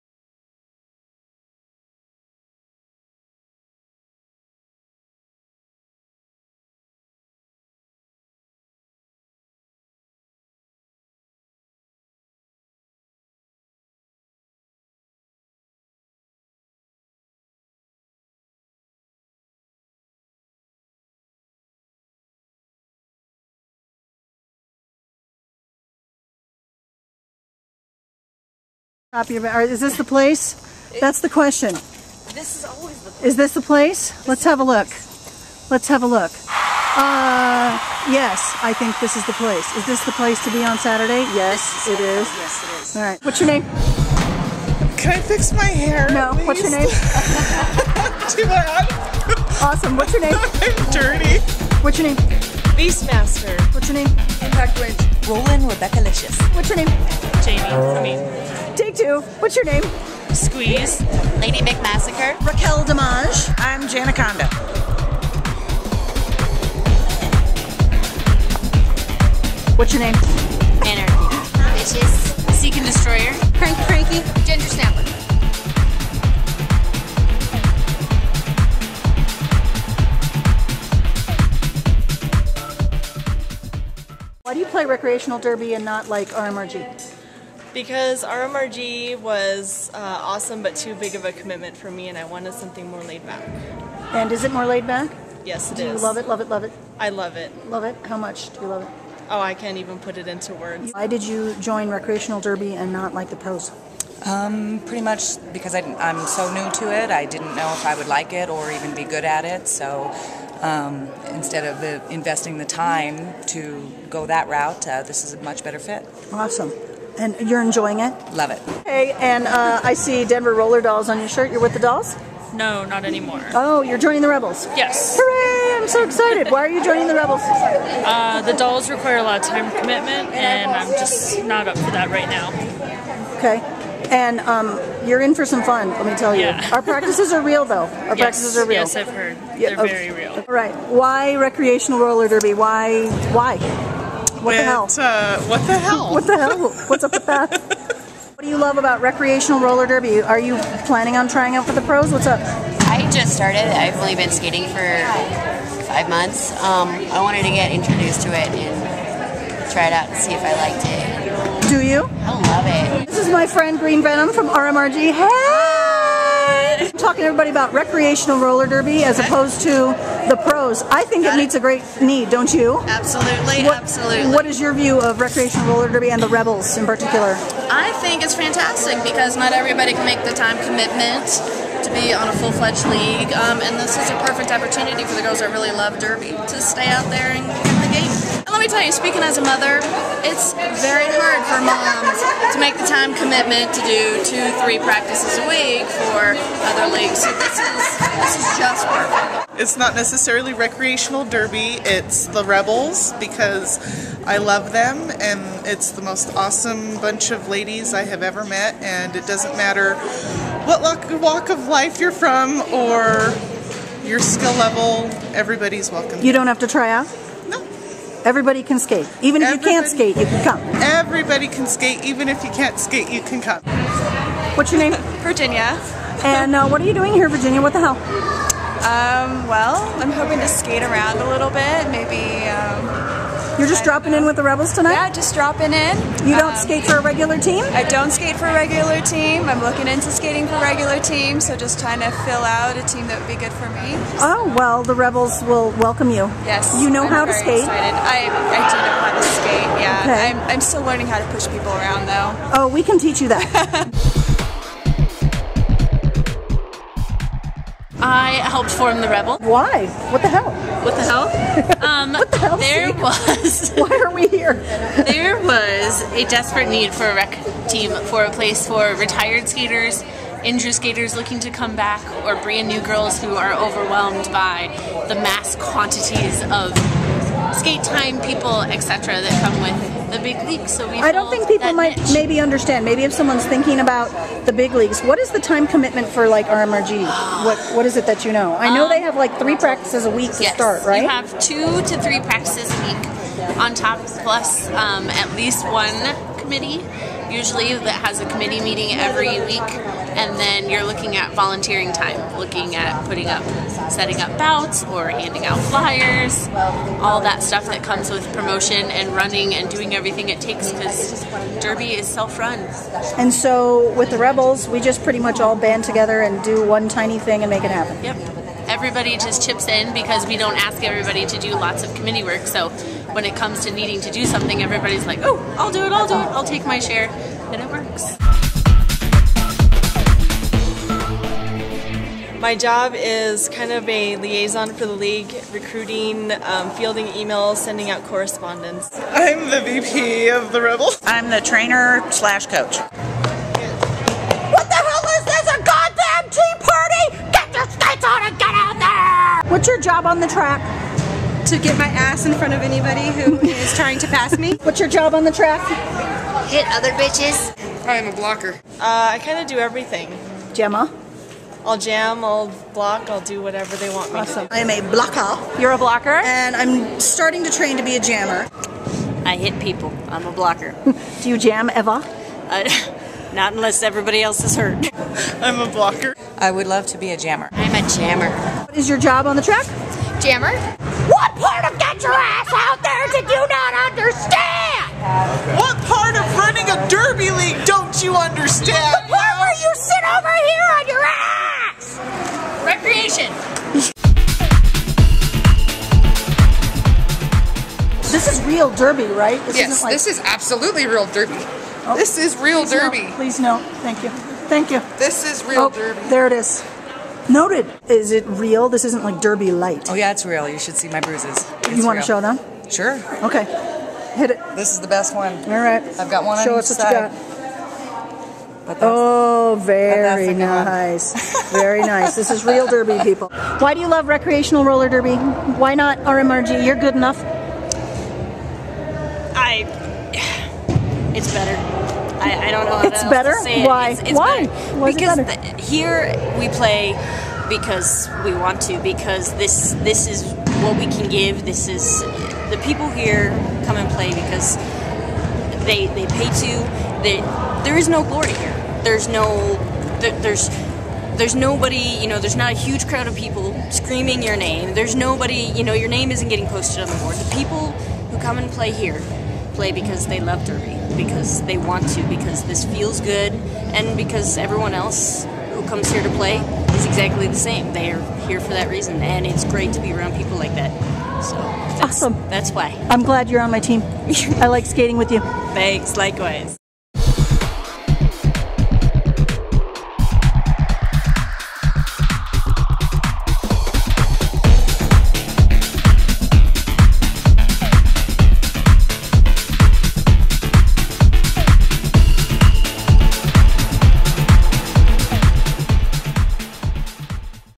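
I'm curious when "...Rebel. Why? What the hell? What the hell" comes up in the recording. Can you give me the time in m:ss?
4:19.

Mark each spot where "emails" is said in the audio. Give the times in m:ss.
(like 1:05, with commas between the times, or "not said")
5:37.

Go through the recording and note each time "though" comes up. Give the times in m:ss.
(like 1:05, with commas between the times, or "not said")
2:17, 4:12.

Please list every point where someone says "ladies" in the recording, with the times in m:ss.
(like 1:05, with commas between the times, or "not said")
3:27.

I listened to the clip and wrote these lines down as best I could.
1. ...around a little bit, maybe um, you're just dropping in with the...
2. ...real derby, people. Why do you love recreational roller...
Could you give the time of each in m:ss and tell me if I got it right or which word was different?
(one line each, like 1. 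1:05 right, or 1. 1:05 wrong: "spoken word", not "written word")
1. 3:50 right
2. 7:02 right.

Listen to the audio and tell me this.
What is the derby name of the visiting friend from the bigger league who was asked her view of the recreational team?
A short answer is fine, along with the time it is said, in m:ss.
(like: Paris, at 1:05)
Green Venom, at 2:43.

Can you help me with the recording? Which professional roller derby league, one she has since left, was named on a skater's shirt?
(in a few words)
Denver Roller Dolls.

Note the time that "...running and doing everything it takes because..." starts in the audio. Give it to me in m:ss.
5:09.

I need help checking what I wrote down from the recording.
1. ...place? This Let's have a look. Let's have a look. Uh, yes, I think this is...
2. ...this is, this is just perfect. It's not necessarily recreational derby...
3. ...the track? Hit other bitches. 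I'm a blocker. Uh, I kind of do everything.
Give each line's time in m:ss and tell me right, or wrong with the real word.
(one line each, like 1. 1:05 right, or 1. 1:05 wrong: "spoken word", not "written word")
1. 0:33 right
2. 3:17 right
3. 5:55 right.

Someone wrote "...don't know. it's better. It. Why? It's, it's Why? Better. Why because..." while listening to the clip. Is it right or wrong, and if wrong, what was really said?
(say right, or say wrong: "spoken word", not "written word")
right.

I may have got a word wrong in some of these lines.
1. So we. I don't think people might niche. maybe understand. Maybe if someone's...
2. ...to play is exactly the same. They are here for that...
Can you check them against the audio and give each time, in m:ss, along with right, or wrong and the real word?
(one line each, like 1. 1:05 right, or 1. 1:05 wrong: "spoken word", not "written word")
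1. 4:40 right
2. 7:46 right.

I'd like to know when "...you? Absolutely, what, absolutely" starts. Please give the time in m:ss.
2:52.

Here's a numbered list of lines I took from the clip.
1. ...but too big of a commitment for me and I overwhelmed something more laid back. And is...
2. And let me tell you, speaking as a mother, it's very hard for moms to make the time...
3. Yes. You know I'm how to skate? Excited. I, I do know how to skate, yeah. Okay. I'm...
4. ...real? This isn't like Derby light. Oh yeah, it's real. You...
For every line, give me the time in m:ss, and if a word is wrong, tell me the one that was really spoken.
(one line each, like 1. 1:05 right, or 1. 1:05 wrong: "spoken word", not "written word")
1. 1:30 wrong: "wanted", not "overwhelmed"
2. 3:08 right
3. 4:06 right
4. 6:48 right.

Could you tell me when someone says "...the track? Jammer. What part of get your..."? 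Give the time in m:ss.
6:19.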